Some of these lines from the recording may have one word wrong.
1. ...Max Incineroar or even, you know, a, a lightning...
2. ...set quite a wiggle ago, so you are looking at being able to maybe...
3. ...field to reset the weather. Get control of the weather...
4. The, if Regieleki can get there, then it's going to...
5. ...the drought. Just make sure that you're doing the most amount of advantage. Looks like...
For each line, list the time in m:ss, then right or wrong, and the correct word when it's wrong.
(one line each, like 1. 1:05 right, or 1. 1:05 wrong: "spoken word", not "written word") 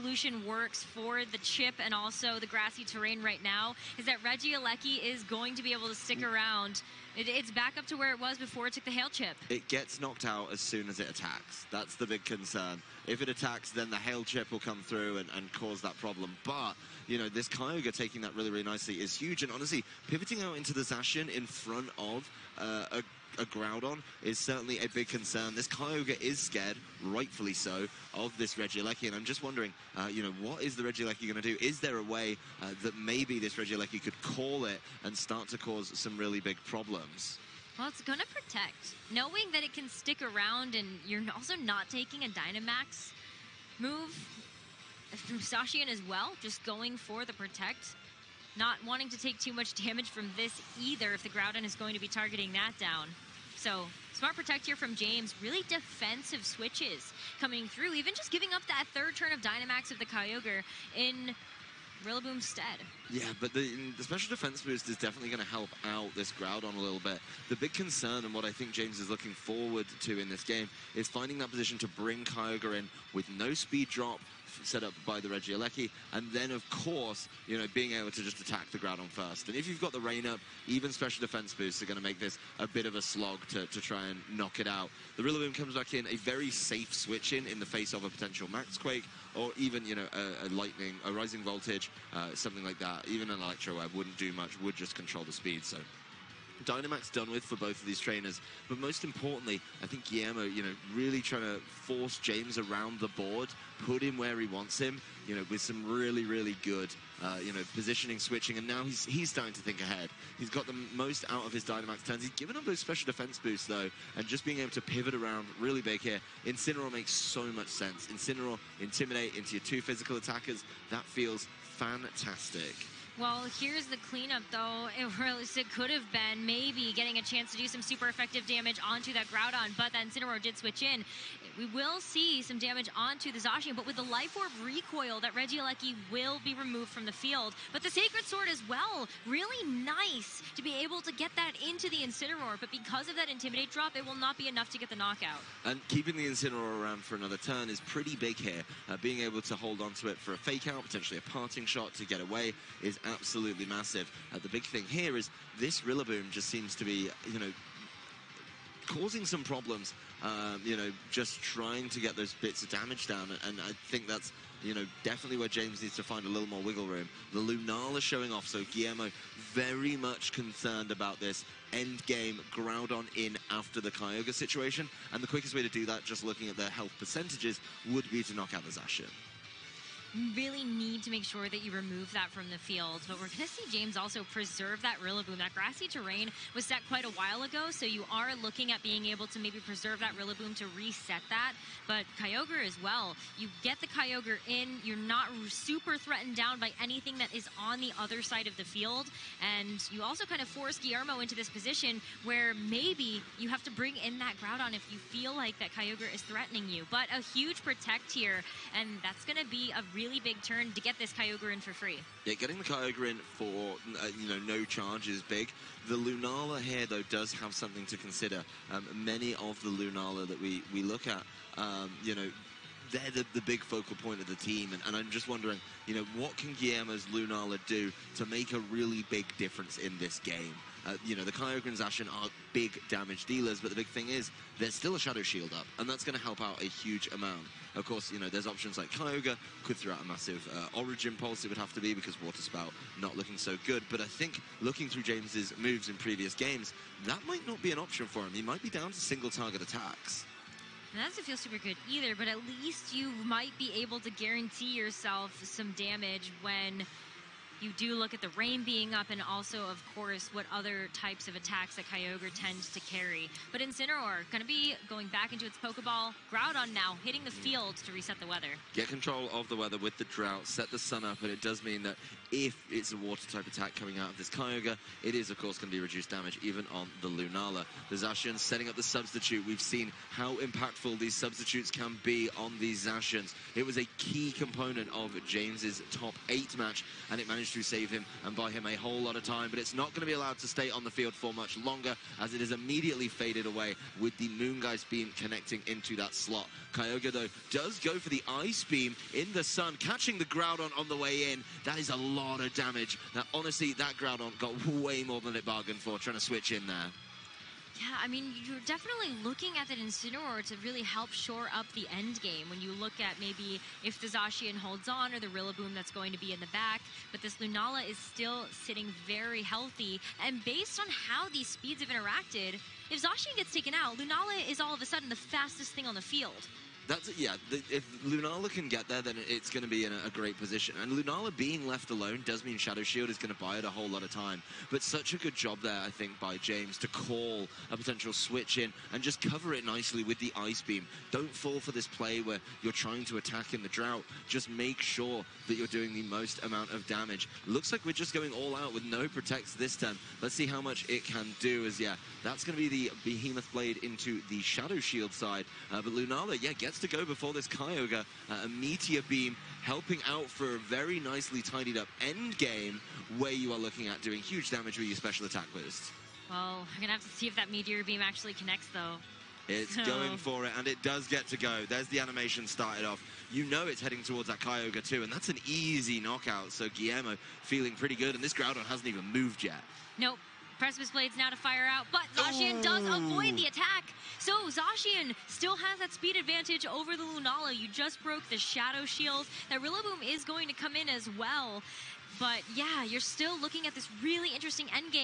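1. 1:28 wrong: "Quake", not "Incineroar"
2. 3:06 wrong: "while", not "wiggle"
3. 4:27 right
4. 5:27 wrong: "Lunala", not "Regieleki"
5. 5:43 wrong: "damage", not "advantage".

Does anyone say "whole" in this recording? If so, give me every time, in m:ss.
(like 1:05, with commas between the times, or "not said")
4:48, 5:33.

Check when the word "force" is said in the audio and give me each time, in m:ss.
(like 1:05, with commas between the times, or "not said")
1:41, 3:20.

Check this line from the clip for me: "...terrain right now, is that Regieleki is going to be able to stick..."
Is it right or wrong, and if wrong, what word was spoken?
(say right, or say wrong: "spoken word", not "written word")
right.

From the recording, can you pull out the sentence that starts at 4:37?
The Zacian setting up the substitute.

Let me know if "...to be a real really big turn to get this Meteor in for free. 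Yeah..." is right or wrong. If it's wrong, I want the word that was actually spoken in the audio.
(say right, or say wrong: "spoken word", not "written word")
wrong: "Kyogre", not "Meteor".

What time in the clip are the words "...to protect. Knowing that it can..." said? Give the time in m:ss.
0:38.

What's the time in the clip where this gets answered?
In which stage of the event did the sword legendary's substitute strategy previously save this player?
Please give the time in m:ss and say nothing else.
4:45.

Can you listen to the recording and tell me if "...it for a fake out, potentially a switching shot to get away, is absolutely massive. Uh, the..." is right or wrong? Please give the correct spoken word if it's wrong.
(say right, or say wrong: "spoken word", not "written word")
wrong: "parting", not "switching".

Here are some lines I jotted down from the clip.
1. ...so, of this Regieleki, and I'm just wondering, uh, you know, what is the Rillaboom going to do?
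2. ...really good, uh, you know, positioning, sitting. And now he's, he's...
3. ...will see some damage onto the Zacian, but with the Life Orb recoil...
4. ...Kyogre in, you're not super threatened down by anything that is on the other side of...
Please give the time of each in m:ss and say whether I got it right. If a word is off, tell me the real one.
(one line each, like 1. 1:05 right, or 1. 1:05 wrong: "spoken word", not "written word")
1. 0:27 wrong: "Regieleki", not "Rillaboom"
2. 1:46 wrong: "switching", not "sitting"
3. 2:11 right
4. 3:13 right.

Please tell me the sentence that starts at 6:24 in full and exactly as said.
So Zacian still has that speed advantage over the Lunala.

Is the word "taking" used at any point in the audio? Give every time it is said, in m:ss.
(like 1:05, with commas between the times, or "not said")
0:17, 0:41.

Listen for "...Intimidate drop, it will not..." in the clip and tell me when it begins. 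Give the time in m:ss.
2:23.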